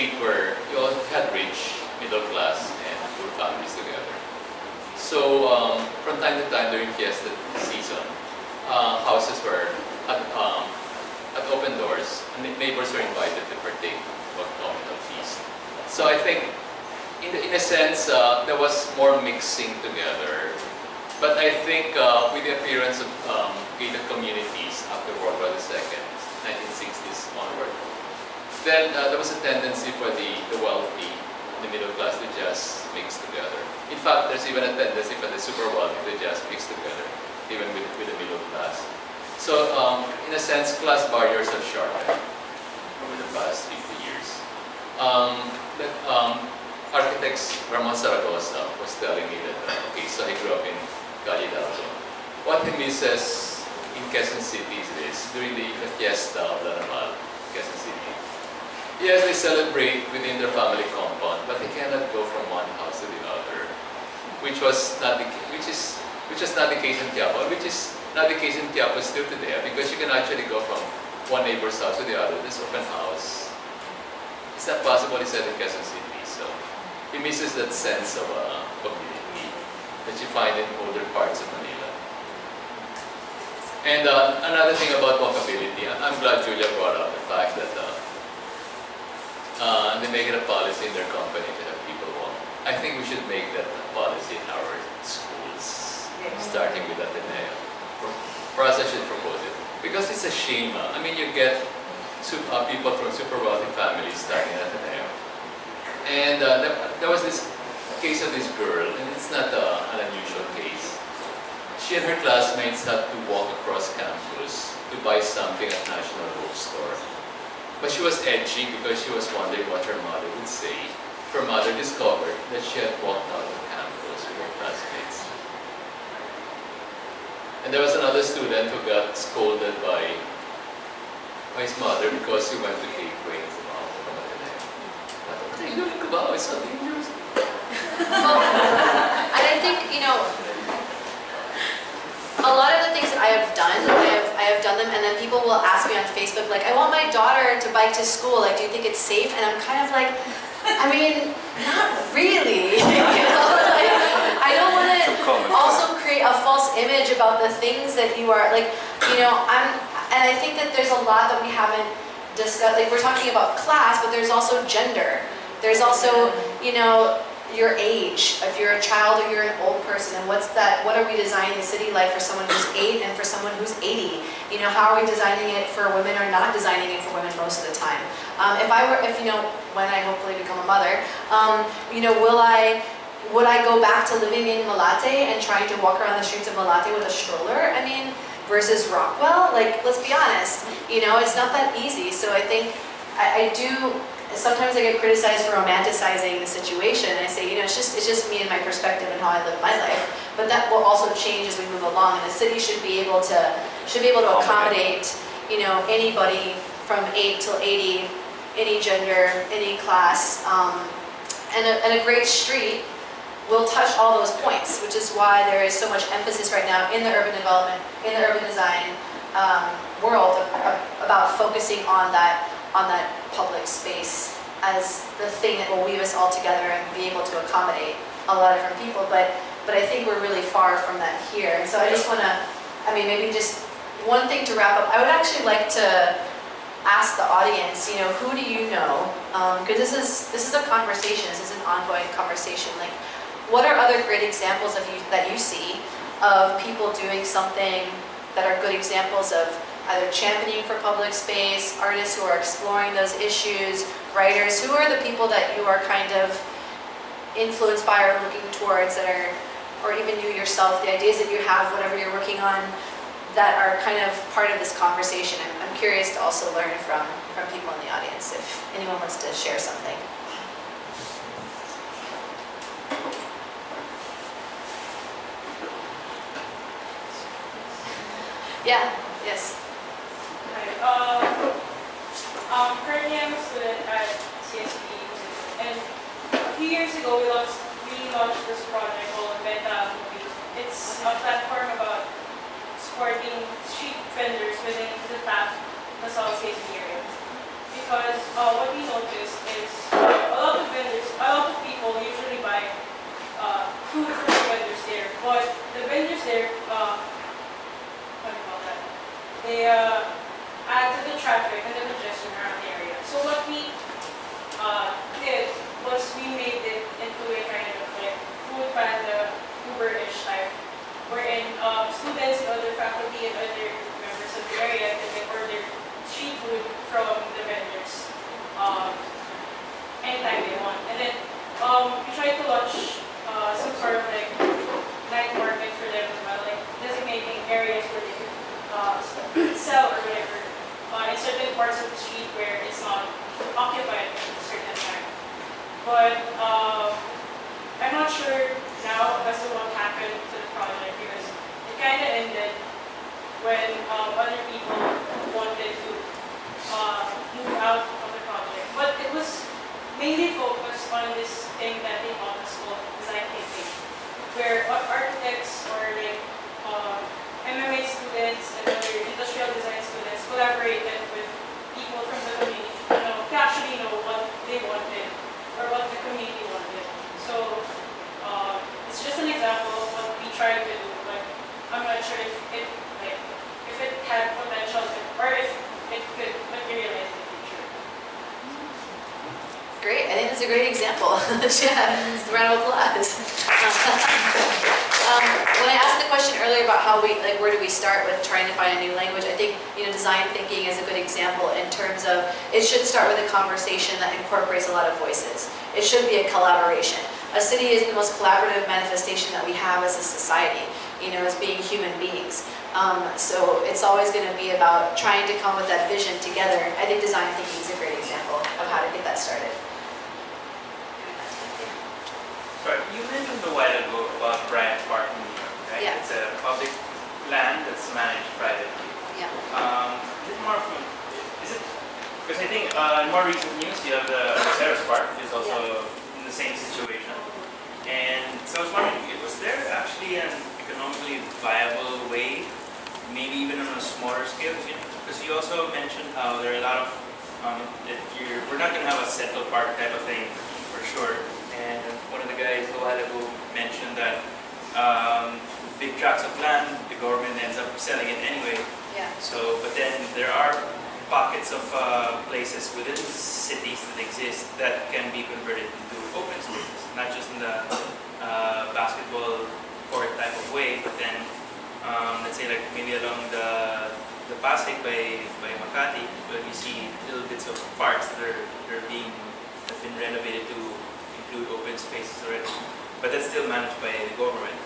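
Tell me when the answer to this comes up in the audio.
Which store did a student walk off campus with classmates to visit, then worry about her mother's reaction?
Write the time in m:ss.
1:55.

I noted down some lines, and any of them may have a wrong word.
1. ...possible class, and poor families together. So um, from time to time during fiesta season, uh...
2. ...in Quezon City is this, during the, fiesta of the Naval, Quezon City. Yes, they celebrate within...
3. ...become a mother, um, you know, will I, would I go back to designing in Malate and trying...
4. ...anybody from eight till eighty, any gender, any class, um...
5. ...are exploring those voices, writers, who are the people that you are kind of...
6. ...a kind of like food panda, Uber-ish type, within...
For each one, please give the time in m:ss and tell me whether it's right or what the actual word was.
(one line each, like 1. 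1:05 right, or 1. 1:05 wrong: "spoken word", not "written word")
1. 0:02 wrong: "middle", not "possible"
2. 0:53 right
3. 3:00 wrong: "living", not "designing"
4. 3:25 right
5. 4:12 wrong: "issues", not "voices"
6. 5:17 wrong: "wherein", not "within".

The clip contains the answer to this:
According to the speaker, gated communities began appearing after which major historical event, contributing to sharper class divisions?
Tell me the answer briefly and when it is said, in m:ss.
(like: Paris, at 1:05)
World War II, at 0:25.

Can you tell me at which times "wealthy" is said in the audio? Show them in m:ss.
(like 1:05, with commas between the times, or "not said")
0:30, 0:35, 1:43.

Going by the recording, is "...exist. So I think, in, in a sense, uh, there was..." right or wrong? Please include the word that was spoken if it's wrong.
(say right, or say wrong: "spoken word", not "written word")
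wrong: "feast", not "exist".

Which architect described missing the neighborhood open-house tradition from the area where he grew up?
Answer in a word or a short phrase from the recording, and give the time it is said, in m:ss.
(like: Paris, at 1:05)
Ramon Zaragoza, at 0:47.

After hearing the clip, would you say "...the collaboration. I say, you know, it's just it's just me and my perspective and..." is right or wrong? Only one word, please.
wrong.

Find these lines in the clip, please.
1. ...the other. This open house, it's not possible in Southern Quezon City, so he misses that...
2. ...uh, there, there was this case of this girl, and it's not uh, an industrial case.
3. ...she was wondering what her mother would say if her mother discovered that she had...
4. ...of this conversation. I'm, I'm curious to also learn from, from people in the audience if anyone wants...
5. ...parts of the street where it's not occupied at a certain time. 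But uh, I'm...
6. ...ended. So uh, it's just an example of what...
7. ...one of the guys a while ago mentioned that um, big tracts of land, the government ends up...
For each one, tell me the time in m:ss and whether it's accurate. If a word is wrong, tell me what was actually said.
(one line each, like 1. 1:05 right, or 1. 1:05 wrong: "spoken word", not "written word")
1. 1:12 right
2. 1:46 wrong: "unusual", not "industrial"
3. 1:59 right
4. 4:24 right
5. 5:41 right
6. 6:16 wrong: "wanted", not "ended"
7. 7:32 right.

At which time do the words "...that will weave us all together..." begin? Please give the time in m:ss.
3:45.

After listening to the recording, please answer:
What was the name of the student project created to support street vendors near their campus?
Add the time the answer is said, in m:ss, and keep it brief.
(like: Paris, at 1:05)
Beta Movie, at 4:49.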